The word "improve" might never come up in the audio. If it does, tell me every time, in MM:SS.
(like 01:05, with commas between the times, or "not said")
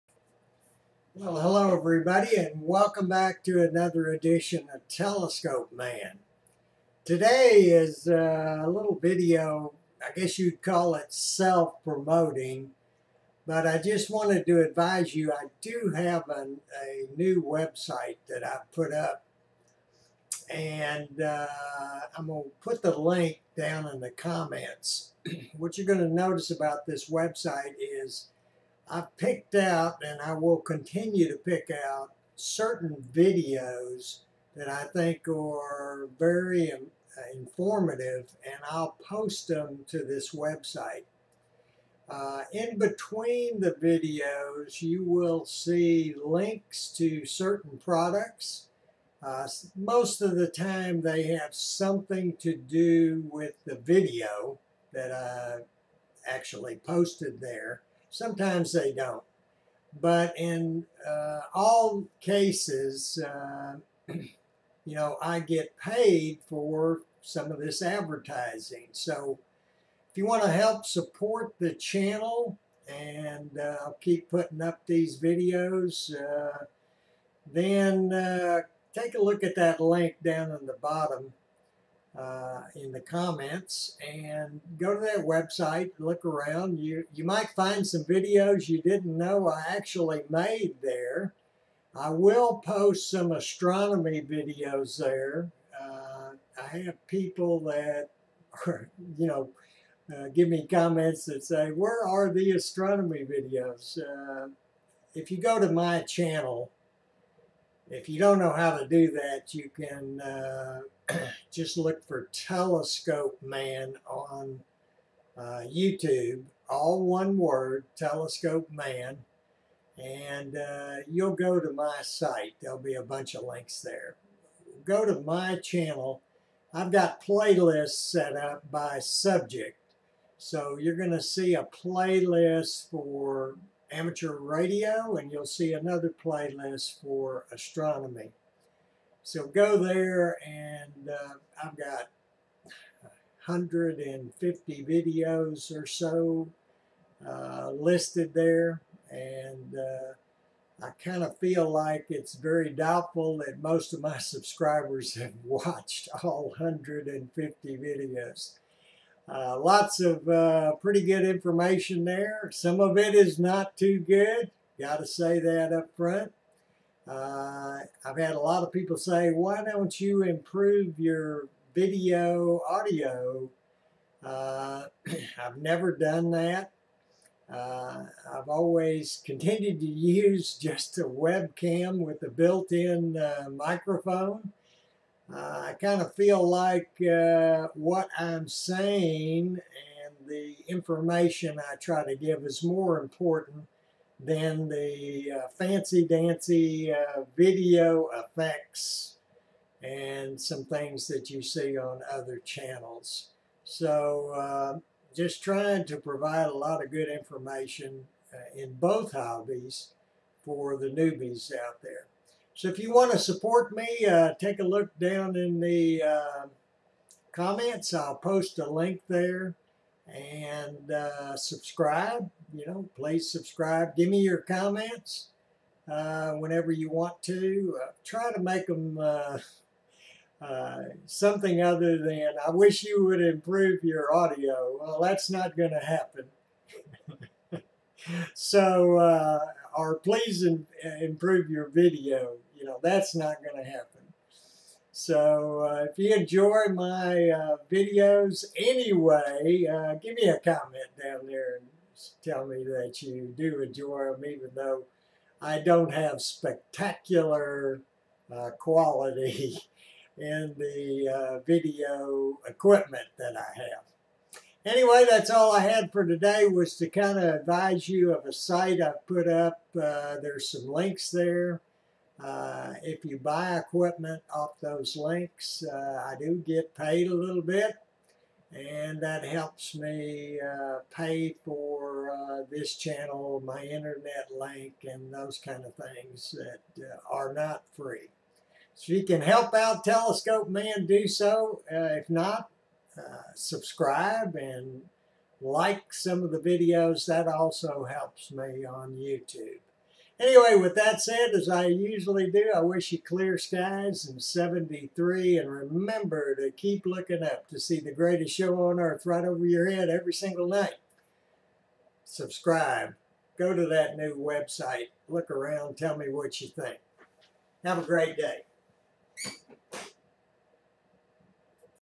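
02:50, 03:53, 04:01.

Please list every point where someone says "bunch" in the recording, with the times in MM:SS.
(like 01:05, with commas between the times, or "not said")
02:03.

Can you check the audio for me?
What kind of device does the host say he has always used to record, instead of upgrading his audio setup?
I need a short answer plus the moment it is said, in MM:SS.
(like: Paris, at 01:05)
a webcam, at 03:00.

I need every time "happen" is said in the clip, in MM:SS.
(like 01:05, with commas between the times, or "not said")
03:55, 04:03.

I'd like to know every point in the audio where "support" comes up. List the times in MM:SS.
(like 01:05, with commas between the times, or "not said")
01:10, 03:33.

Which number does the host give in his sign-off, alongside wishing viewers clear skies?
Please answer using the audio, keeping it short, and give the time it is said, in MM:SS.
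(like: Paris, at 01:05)
73, at 05:04.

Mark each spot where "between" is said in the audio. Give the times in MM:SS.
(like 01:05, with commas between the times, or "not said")
00:42.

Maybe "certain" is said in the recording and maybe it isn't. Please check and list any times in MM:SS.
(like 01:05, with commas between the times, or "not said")
00:32, 00:47.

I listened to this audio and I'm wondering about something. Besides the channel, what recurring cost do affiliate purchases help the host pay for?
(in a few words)
internet link.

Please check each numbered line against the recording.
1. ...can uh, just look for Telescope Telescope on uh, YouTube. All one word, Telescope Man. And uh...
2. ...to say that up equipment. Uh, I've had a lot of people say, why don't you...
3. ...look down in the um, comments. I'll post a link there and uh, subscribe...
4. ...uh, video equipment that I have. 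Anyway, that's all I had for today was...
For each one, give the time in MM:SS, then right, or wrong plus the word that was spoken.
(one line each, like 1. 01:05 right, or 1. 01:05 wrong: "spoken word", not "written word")
1. 01:49 wrong: "Man", not "Telescope"
2. 02:44 wrong: "front", not "equipment"
3. 03:34 right
4. 04:21 right.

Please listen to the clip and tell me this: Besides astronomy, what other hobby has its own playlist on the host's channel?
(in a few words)
amateur radio.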